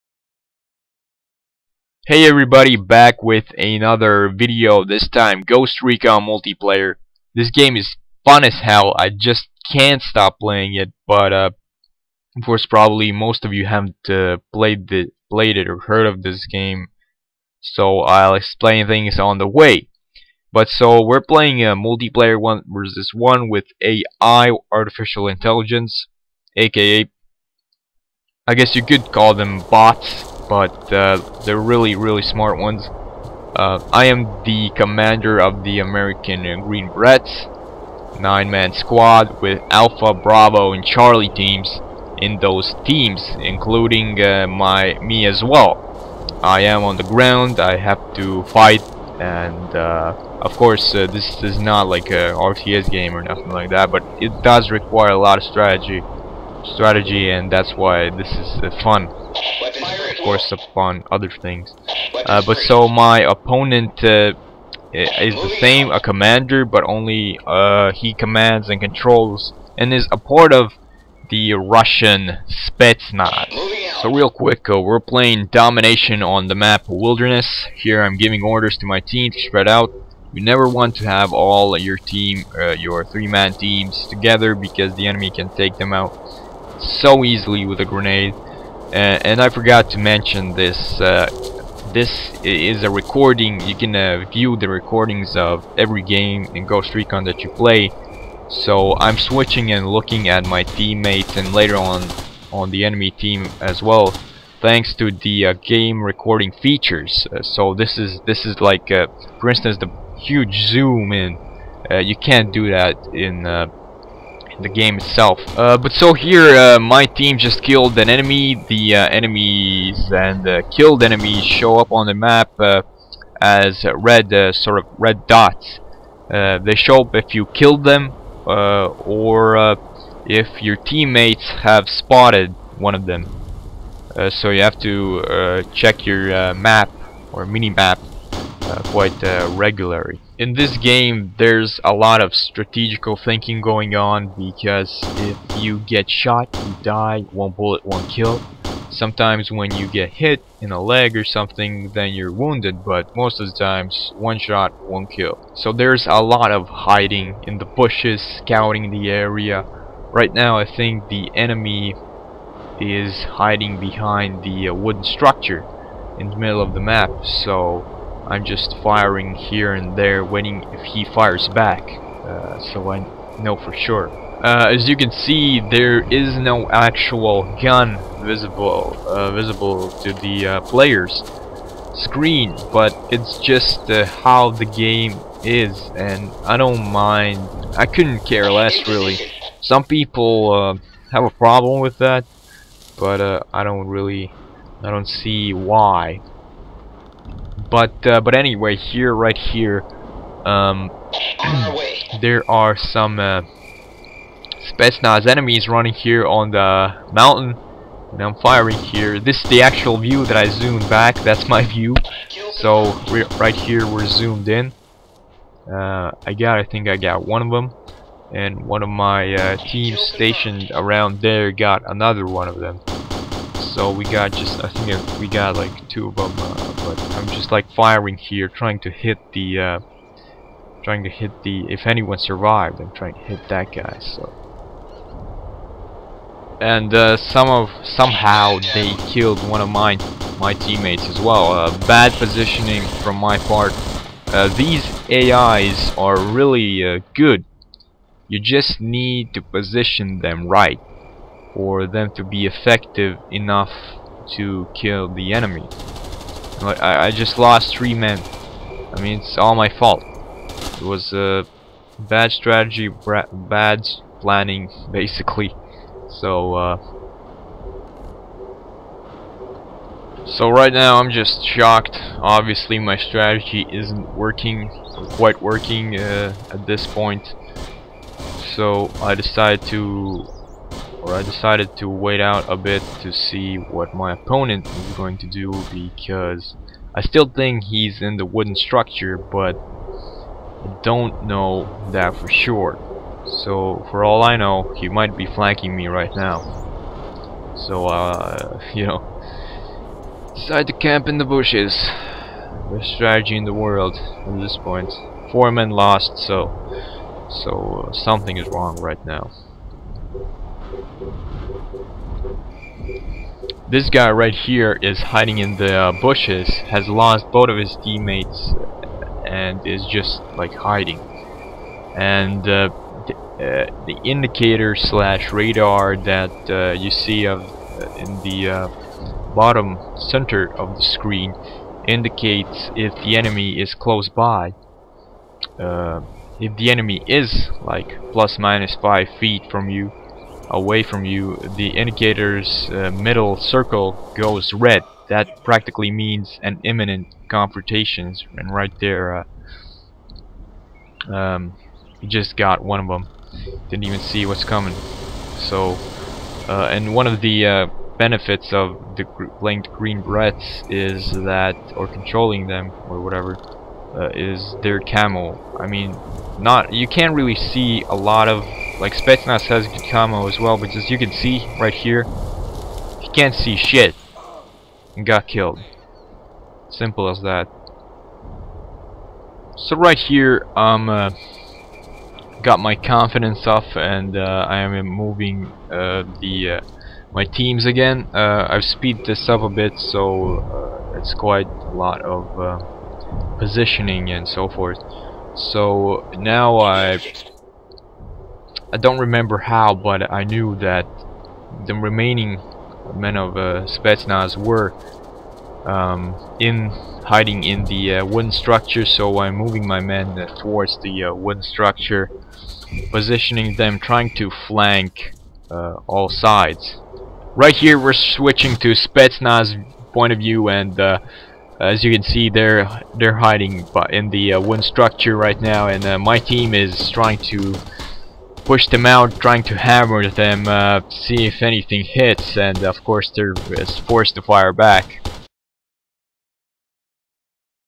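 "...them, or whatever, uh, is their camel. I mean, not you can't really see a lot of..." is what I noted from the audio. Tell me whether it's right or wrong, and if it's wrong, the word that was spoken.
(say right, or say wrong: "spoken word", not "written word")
right.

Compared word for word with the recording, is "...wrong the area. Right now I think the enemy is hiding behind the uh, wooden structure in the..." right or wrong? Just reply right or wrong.
wrong.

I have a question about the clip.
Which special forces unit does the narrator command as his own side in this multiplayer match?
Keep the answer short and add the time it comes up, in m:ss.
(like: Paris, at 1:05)
American Green Berets, at 0:35.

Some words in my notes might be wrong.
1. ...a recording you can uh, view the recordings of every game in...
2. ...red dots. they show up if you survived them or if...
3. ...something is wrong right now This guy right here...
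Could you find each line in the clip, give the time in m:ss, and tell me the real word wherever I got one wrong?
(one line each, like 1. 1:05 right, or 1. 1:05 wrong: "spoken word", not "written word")
1. 1:32 right
2. 2:04 wrong: "killed", not "survived"
3. 5:07 right.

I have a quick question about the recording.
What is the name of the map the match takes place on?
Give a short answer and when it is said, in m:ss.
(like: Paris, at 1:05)
Wilderness, at 1:16.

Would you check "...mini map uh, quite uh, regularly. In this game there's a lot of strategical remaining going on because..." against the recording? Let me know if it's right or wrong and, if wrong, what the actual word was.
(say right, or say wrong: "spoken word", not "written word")
wrong: "thinking", not "remaining".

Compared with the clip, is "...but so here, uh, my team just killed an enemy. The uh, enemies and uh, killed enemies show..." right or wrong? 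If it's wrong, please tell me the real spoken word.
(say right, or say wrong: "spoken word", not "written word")
right.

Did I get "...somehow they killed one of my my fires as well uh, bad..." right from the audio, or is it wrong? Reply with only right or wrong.
wrong.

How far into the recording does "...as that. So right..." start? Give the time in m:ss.
6:17.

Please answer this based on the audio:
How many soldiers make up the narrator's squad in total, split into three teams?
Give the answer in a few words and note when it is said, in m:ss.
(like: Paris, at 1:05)
9, at 0:38.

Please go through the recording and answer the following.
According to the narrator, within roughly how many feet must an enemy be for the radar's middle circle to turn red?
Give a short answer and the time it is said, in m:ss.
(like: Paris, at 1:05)
5 feet, at 5:38.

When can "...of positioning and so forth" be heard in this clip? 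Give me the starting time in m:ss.
6:32.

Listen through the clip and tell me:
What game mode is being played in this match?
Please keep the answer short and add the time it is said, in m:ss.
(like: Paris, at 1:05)
Domination, at 1:15.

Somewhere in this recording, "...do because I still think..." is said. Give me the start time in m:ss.
4:45.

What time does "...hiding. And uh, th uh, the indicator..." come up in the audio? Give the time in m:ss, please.
5:20.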